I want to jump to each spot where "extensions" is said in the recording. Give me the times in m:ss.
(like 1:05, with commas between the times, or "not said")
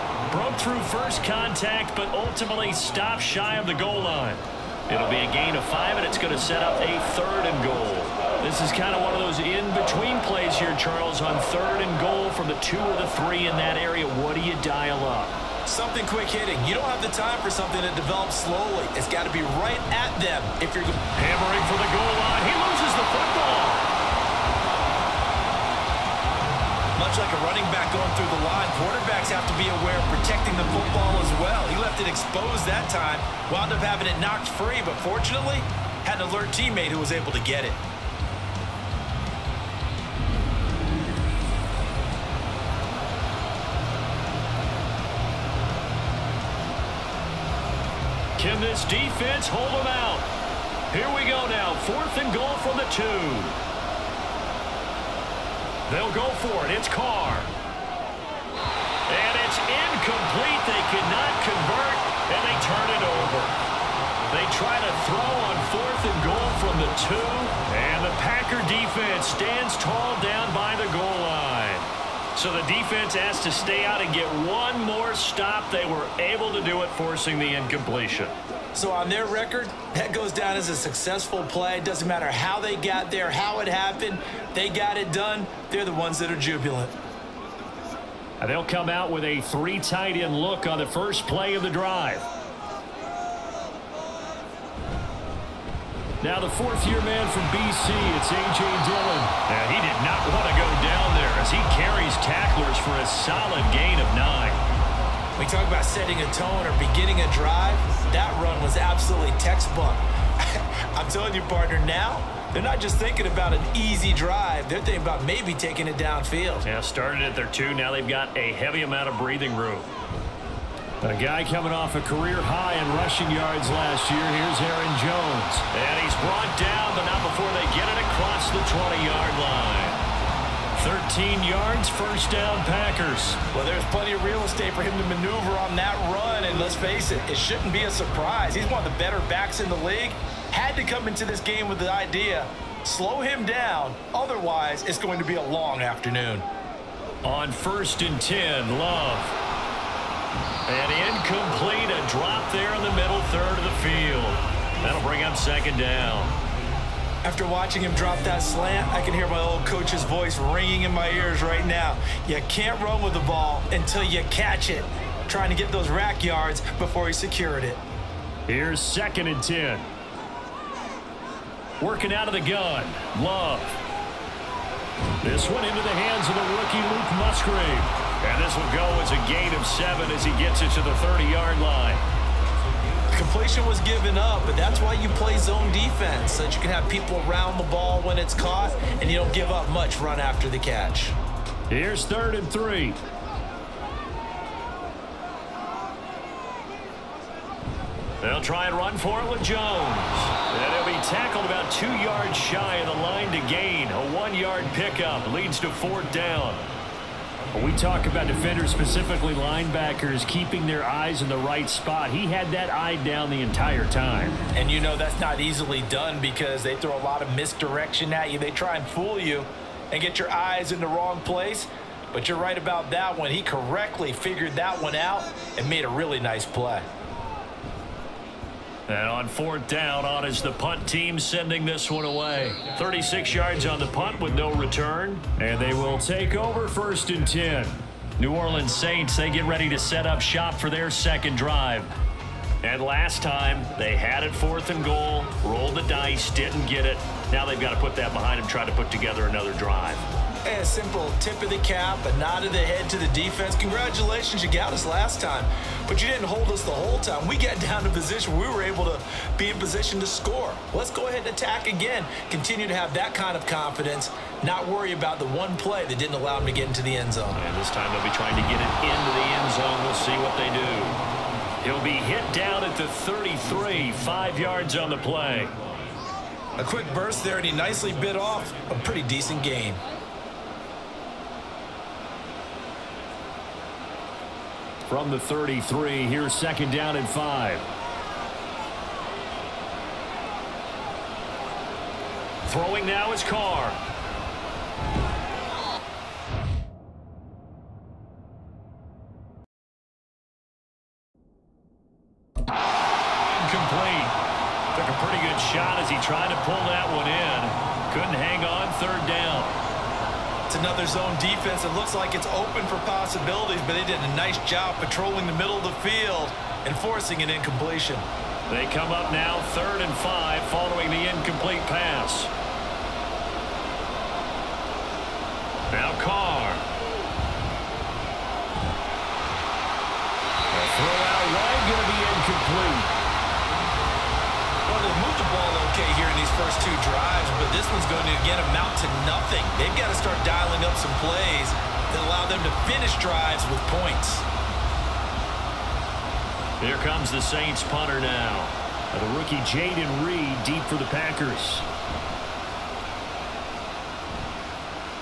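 not said.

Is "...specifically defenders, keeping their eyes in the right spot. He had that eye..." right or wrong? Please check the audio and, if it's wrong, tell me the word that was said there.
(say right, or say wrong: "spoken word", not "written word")
wrong: "linebackers", not "defenders".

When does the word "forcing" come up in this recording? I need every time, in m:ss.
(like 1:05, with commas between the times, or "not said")
1:16, 5:16.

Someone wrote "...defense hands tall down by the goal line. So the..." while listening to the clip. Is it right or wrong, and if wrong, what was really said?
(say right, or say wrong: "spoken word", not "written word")
wrong: "stands", not "hands".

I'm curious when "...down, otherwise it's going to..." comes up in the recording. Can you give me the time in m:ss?
2:23.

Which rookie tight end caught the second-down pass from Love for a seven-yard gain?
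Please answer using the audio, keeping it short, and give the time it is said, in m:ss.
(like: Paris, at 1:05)
Luke Musgrave, at 2:56.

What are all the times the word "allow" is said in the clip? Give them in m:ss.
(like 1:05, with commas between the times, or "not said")
4:26, 5:42.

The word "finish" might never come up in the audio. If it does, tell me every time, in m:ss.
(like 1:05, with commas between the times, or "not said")
5:42.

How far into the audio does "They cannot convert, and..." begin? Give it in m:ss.
1:00.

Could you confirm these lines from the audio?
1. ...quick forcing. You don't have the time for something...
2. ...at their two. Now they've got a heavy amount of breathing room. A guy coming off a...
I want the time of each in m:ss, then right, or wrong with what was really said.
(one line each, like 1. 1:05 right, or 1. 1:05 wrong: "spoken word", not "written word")
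1. 0:16 wrong: "hitting", not "forcing"
2. 1:57 right.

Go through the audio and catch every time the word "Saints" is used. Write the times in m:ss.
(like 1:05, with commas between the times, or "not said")
3:58, 5:47.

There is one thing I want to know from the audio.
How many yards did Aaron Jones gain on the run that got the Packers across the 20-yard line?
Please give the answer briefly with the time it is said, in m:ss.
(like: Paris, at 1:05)
13, at 2:10.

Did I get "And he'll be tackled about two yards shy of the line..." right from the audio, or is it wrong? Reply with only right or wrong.
right.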